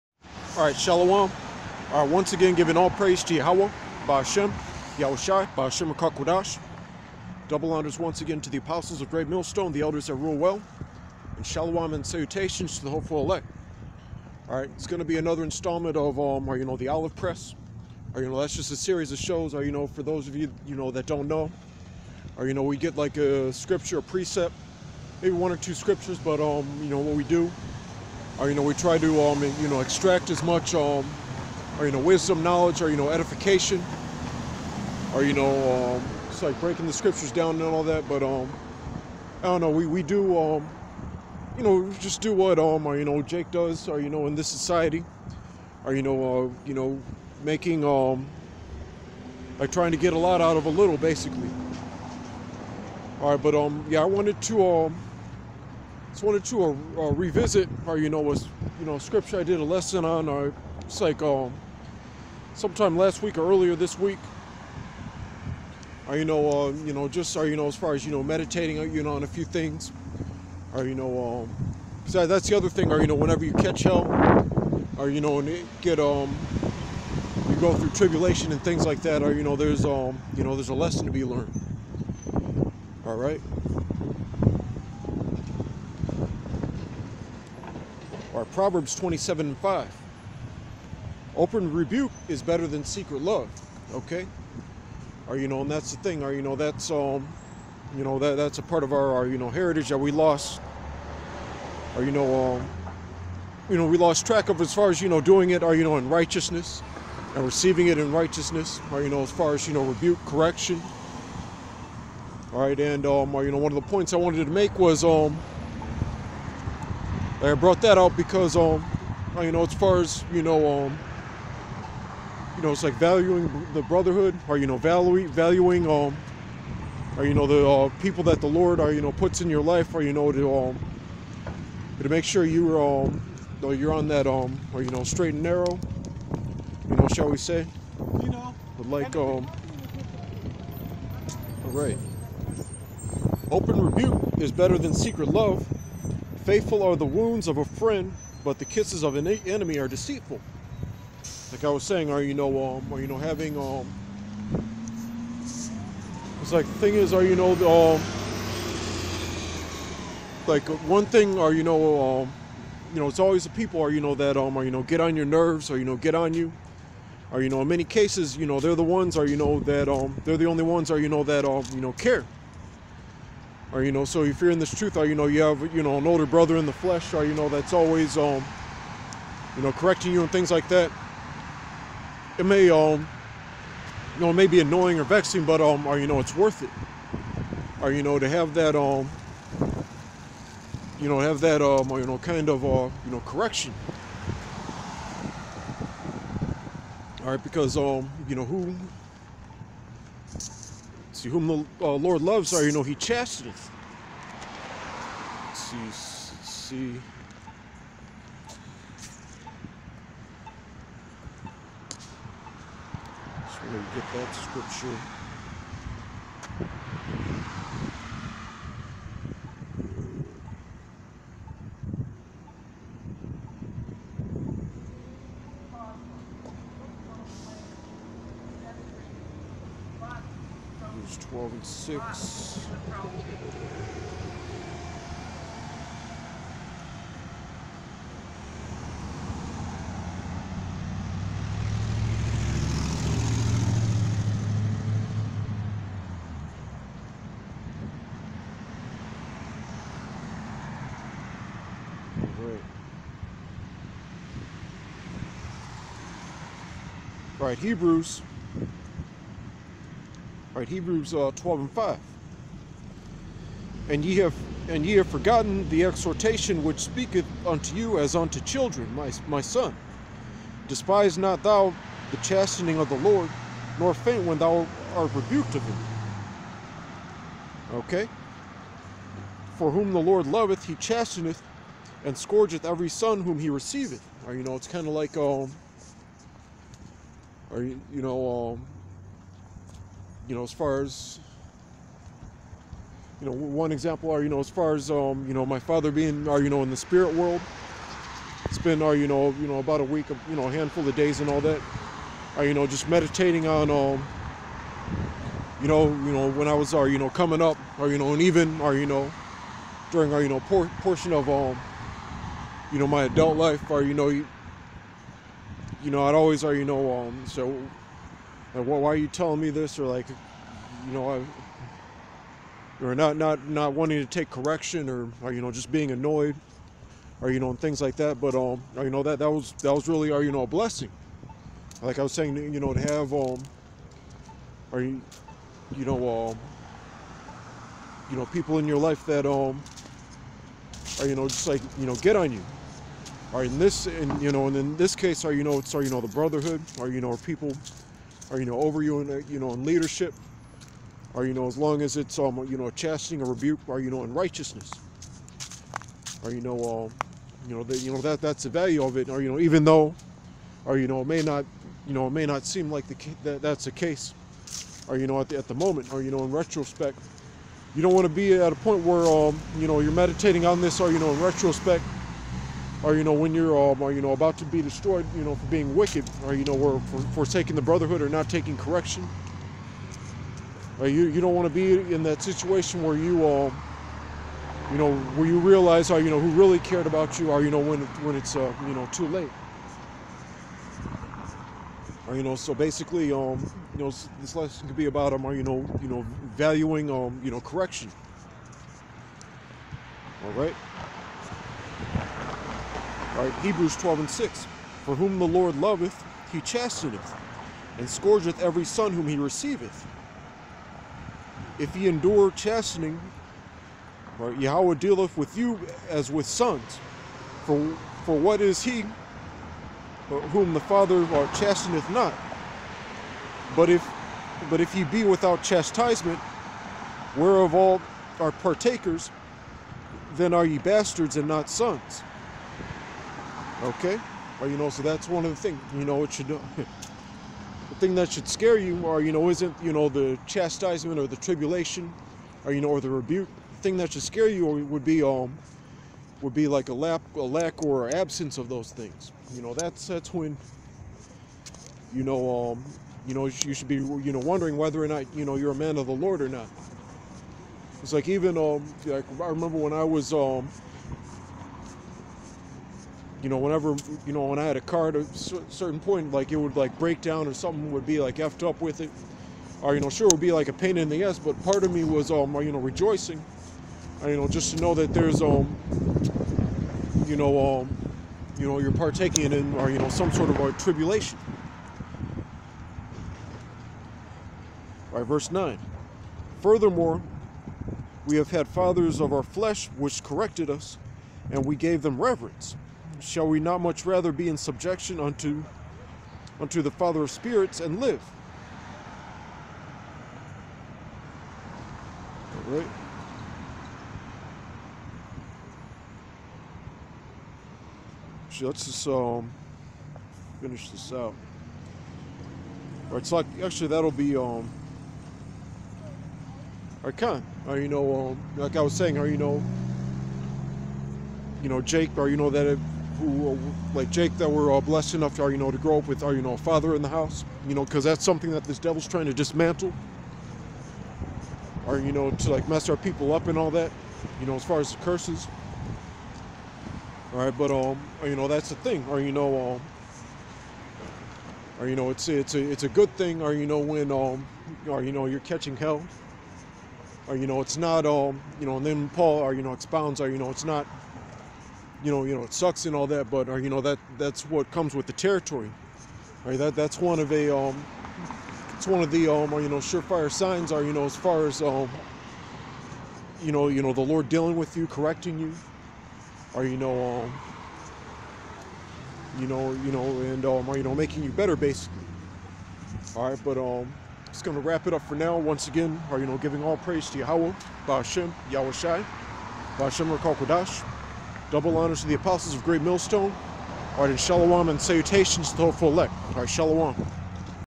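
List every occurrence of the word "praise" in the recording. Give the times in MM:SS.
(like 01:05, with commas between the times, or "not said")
00:02, 09:36.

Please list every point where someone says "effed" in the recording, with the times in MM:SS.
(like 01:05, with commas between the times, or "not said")
07:48.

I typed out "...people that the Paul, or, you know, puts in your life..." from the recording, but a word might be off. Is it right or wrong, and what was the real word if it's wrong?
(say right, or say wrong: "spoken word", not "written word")
wrong: "Lord", not "Paul".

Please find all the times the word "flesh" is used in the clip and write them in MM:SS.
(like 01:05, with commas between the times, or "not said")
02:56, 08:09.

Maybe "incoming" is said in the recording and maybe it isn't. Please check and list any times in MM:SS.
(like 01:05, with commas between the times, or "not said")
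not said.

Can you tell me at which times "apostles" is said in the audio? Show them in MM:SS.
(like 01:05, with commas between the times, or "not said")
00:08, 09:41.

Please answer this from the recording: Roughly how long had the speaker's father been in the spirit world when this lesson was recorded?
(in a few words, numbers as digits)
About a week.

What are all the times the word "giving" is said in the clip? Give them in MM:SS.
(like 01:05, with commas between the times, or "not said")
00:02, 09:36.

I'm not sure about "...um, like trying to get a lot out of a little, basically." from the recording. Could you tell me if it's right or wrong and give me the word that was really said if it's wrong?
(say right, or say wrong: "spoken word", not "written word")
right.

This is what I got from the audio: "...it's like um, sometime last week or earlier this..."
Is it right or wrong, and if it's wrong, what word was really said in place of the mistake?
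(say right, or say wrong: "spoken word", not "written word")
right.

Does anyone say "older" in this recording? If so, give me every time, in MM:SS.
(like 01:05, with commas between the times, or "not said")
02:56.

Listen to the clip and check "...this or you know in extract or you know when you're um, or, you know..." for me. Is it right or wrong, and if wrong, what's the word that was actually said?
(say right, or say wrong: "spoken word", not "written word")
wrong: "retrospect", not "extract".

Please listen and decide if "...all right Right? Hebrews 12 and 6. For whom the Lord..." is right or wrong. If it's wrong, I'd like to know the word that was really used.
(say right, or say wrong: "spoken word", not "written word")
right.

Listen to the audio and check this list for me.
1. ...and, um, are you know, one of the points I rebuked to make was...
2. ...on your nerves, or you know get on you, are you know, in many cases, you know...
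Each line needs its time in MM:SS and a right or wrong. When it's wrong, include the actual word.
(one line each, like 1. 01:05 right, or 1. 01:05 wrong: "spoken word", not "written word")
1. 01:52 wrong: "wanted", not "rebuked"
2. 02:44 right.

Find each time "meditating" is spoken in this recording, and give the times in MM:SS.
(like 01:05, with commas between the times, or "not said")
01:08, 05:02, 06:09.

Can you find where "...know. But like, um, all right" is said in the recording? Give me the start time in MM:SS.
02:18.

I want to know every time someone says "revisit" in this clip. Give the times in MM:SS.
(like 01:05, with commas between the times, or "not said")
00:57.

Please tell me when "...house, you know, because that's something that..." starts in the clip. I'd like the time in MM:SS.
08:46.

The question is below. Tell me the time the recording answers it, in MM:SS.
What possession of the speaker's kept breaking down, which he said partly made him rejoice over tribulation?
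07:44.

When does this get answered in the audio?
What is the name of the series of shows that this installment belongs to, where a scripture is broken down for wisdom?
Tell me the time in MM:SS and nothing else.
00:16.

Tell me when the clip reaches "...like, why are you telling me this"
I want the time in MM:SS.
05:18.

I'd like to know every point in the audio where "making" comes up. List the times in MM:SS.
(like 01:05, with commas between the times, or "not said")
00:47, 09:30.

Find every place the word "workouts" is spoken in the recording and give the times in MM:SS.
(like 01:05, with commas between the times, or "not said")
not said.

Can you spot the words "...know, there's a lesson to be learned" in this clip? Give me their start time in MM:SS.
01:20.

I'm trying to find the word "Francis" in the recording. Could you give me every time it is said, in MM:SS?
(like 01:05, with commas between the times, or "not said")
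not said.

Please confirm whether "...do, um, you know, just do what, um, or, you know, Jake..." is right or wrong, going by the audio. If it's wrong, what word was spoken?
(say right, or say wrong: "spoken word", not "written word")
right.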